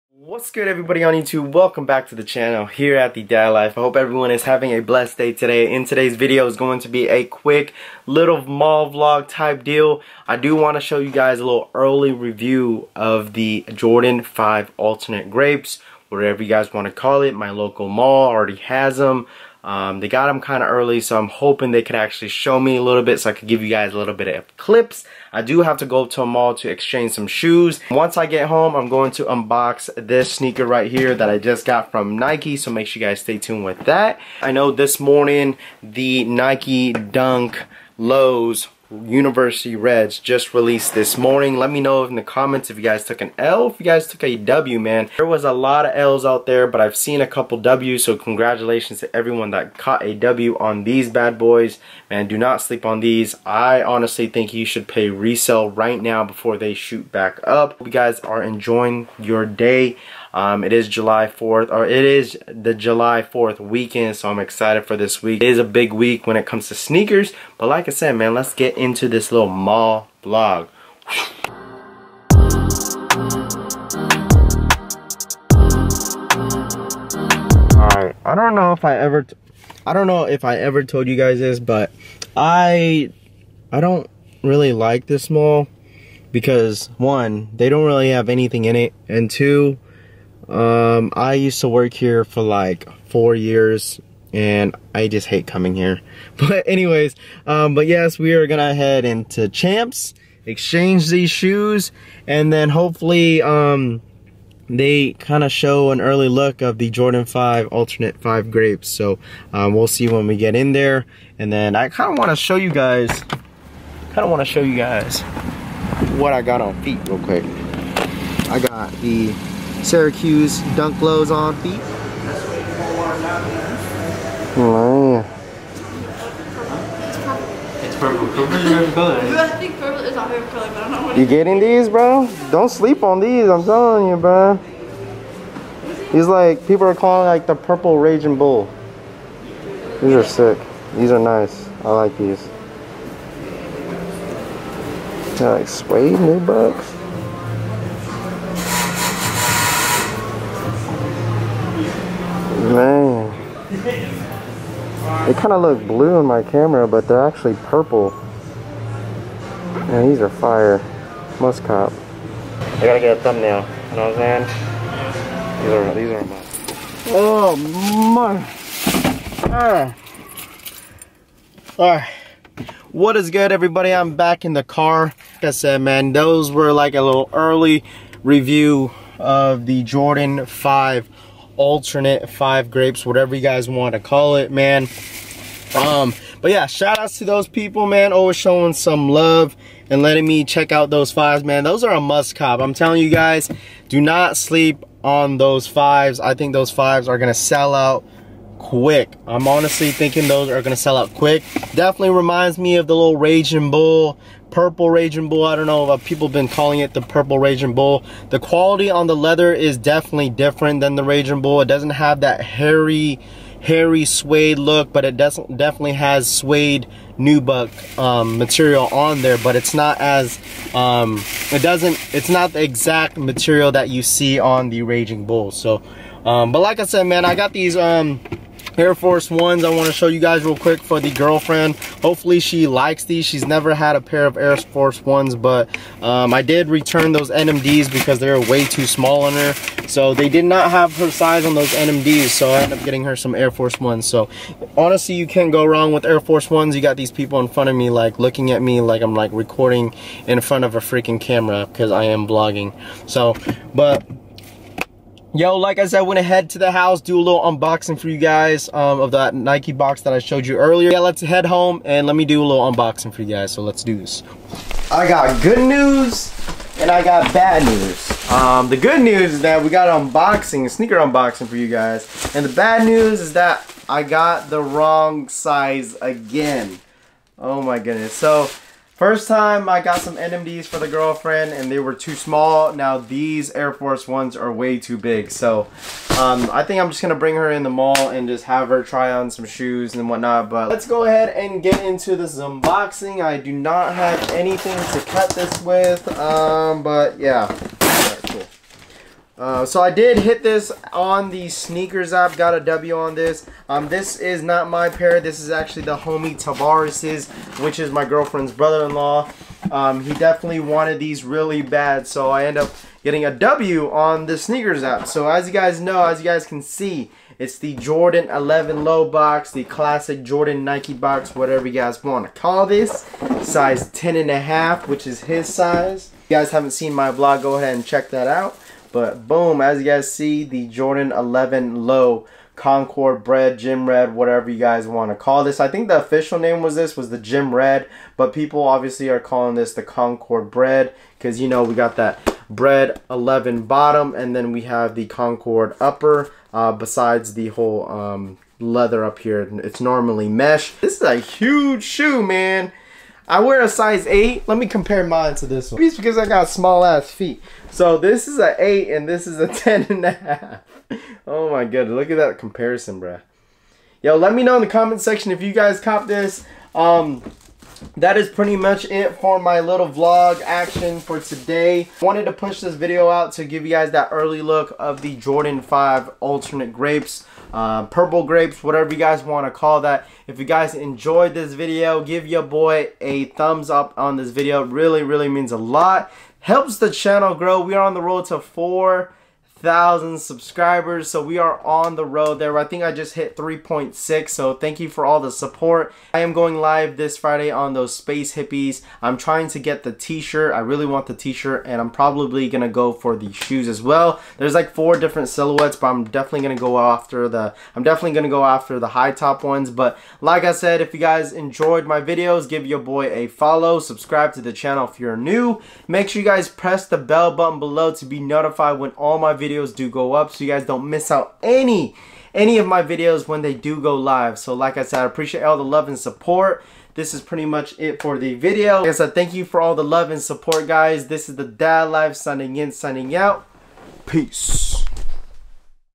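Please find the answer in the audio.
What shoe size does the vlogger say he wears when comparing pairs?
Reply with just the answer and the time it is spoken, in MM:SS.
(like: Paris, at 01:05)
8, at 05:53.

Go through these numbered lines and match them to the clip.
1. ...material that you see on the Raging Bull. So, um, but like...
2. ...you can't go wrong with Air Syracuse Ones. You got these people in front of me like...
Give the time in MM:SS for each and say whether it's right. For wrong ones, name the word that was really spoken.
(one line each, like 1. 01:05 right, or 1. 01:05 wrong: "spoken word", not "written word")
1. 03:43 right
2. 04:05 wrong: "Force", not "Syracuse".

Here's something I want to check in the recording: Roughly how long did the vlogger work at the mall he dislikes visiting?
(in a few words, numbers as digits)
4 years.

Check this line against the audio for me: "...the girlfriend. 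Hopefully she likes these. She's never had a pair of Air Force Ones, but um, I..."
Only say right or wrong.
right.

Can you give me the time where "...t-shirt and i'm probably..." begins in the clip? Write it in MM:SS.
06:41.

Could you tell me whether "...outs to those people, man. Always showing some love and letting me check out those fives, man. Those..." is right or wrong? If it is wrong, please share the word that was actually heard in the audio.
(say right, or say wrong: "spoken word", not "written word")
right.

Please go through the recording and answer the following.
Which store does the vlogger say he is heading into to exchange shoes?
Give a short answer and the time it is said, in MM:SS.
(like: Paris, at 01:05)
Champs, at 01:39.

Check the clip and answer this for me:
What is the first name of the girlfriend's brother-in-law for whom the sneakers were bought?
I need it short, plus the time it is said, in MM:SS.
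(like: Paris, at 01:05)
Tavares, at 05:06.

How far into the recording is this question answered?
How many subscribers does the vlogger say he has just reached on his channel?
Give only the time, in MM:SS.
06:33.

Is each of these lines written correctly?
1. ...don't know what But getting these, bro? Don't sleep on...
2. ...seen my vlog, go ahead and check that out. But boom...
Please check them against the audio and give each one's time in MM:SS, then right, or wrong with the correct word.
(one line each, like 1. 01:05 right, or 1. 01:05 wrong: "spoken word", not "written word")
1. 02:10 wrong: "You", not "But"
2. 05:26 right.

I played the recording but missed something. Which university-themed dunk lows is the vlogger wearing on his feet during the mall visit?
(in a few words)
Syracuse.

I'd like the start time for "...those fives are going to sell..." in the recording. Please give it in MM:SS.
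03:16.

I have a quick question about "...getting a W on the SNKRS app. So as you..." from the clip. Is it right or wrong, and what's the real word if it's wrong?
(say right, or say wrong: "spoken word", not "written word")
right.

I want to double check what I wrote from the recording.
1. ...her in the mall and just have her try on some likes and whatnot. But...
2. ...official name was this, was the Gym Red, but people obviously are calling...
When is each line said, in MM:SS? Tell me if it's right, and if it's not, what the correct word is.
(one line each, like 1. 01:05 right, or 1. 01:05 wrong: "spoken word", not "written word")
1. 04:47 wrong: "shoes", not "likes"
2. 05:35 right.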